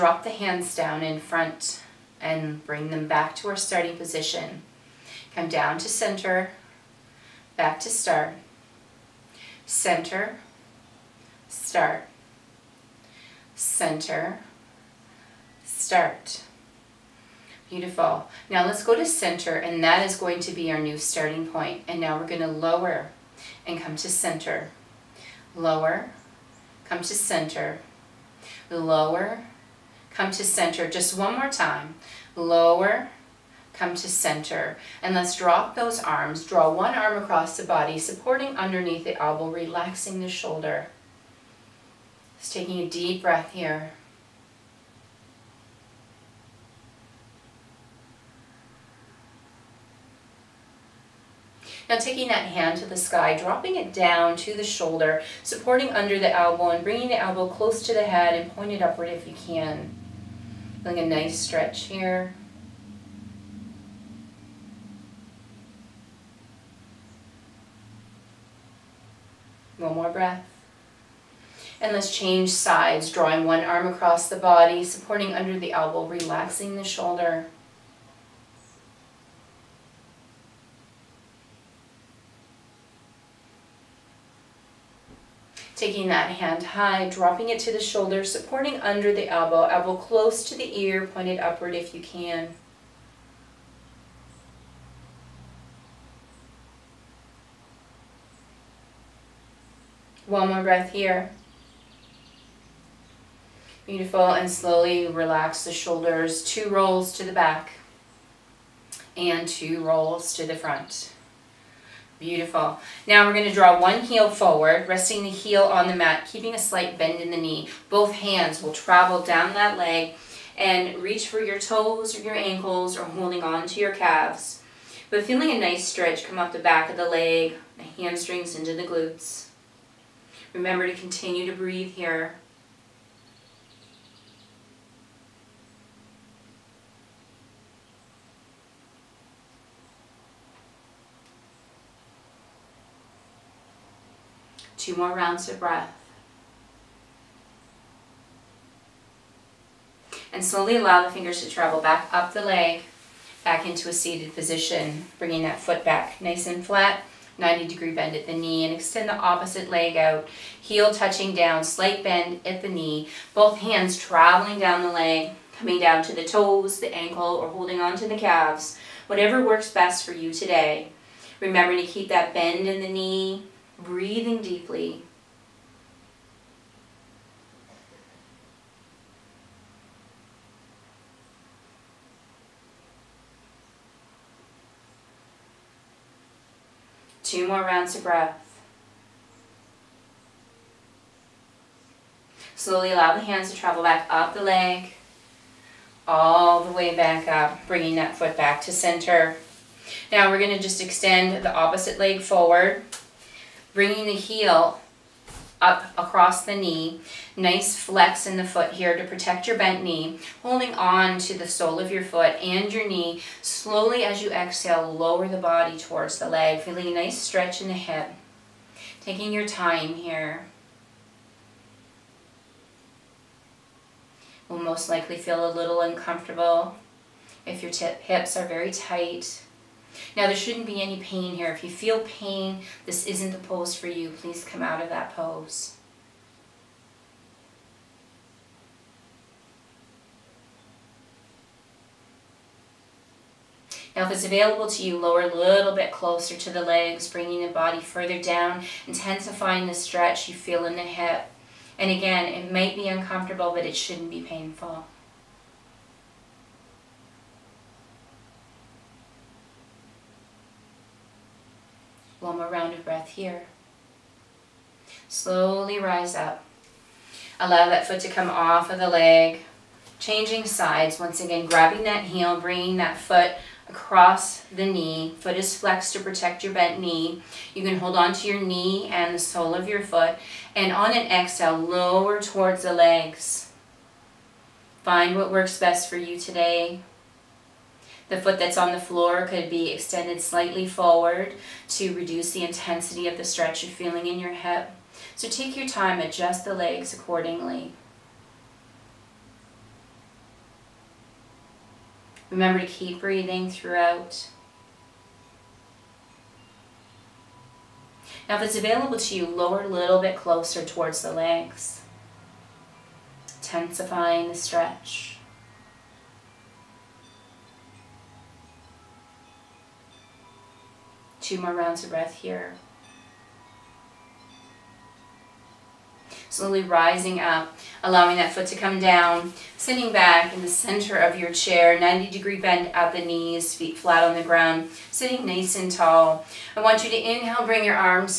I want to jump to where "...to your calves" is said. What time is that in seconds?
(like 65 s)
123 s.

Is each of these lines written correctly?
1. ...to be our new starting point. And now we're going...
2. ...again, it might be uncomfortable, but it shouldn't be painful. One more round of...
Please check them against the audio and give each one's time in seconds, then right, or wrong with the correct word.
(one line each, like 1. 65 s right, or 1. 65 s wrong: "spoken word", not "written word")
1. 20 s right
2. 251 s right.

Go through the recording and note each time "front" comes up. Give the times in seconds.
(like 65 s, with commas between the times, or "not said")
1 s, 110 s.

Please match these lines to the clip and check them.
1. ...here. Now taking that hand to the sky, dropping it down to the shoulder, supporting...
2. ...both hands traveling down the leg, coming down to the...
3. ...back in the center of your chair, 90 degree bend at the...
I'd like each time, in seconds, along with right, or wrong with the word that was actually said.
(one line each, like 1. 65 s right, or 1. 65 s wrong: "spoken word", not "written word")
1. 43 s right
2. 163 s right
3. 329 s right.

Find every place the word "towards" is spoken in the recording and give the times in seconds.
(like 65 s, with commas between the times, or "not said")
215 s, 282 s, 310 s.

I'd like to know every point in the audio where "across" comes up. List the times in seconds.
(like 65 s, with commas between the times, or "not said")
37 s, 73 s, 205 s, 273 s.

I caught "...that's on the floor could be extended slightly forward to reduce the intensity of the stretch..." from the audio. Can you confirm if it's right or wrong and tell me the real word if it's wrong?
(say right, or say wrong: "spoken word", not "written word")
right.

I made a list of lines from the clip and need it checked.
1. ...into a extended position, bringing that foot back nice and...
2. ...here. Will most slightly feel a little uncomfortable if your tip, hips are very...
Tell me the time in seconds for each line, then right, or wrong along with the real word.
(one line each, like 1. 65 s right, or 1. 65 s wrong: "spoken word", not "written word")
1. 153 s wrong: "seated", not "extended"
2. 219 s wrong: "likely", not "slightly".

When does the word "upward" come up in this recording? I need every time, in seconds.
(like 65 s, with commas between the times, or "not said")
58 s, 91 s.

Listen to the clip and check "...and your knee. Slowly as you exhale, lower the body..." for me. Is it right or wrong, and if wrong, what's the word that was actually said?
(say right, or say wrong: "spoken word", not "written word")
right.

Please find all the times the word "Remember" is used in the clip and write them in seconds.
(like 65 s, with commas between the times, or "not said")
130 s, 171 s, 302 s.